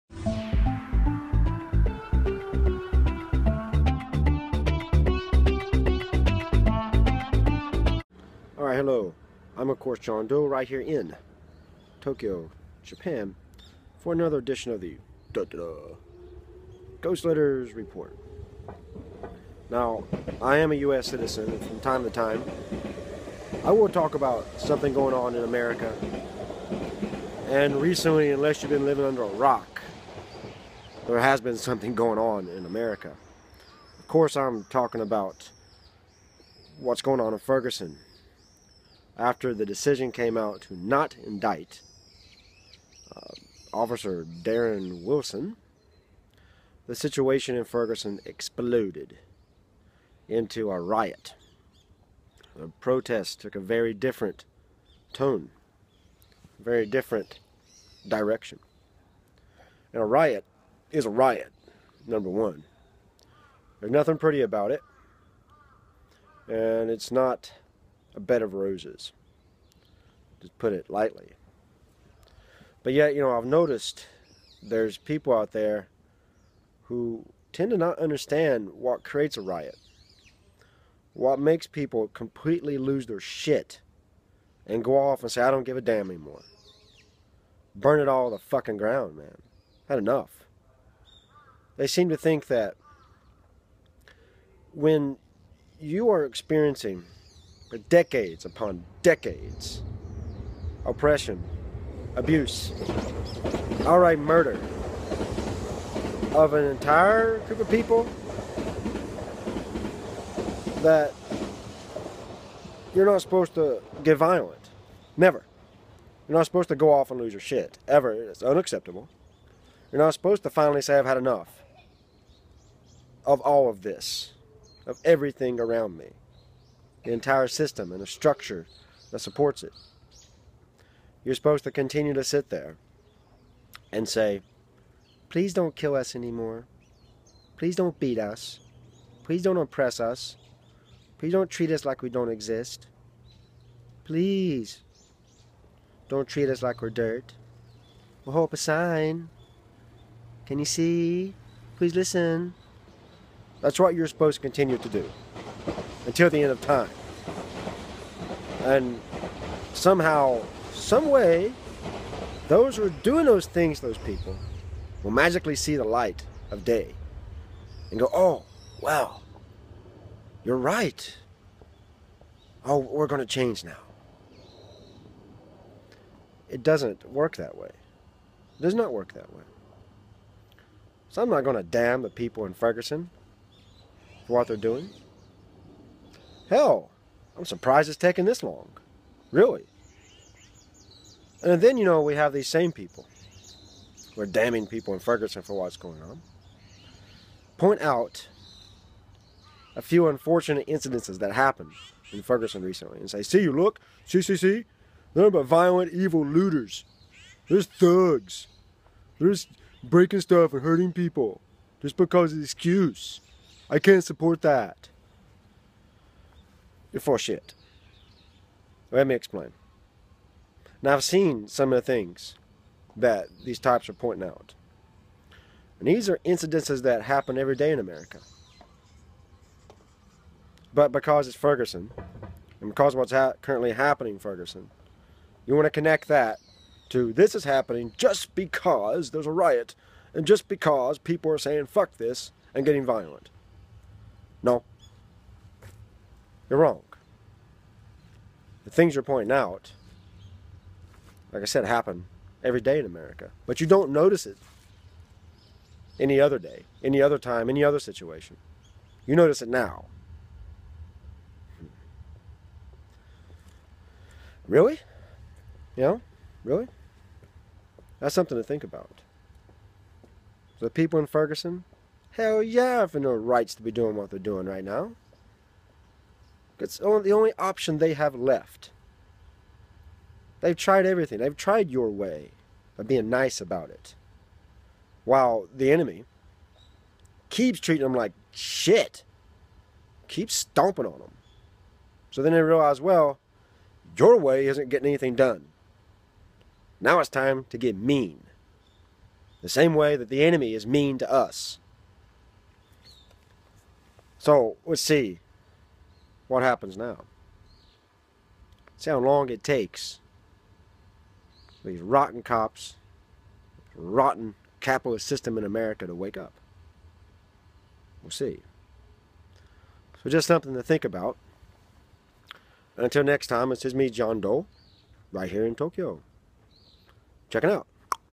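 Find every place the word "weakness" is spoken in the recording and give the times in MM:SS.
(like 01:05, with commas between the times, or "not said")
not said.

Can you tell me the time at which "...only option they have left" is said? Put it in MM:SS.
04:37.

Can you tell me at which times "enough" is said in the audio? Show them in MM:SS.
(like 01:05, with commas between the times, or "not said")
01:29, 02:01.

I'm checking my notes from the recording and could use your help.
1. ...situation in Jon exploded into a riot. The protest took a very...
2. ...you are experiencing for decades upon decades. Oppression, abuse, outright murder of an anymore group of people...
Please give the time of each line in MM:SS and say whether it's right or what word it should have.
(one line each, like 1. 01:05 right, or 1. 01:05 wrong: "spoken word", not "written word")
1. 00:46 wrong: "Ferguson", not "Jon"
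2. 01:35 wrong: "entire", not "anymore".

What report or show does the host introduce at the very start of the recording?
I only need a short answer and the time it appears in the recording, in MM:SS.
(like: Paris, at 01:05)
Ghost Letters Report, at 00:16.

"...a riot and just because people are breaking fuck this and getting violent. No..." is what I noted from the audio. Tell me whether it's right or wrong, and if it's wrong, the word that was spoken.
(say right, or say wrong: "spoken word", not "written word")
wrong: "saying", not "breaking".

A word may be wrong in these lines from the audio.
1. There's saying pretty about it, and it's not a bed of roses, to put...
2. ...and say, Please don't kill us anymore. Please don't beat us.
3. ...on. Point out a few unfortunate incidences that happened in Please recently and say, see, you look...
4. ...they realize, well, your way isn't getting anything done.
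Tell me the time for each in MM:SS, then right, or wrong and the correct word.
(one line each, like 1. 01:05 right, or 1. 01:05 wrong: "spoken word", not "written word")
1. 01:03 wrong: "nothing", not "saying"
2. 02:13 right
3. 03:16 wrong: "Ferguson", not "Please"
4. 04:52 right.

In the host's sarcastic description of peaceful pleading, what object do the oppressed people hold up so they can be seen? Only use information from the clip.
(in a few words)
a sign.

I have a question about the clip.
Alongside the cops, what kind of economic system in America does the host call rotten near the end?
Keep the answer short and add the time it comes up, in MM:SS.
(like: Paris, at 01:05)
capitalist, at 05:14.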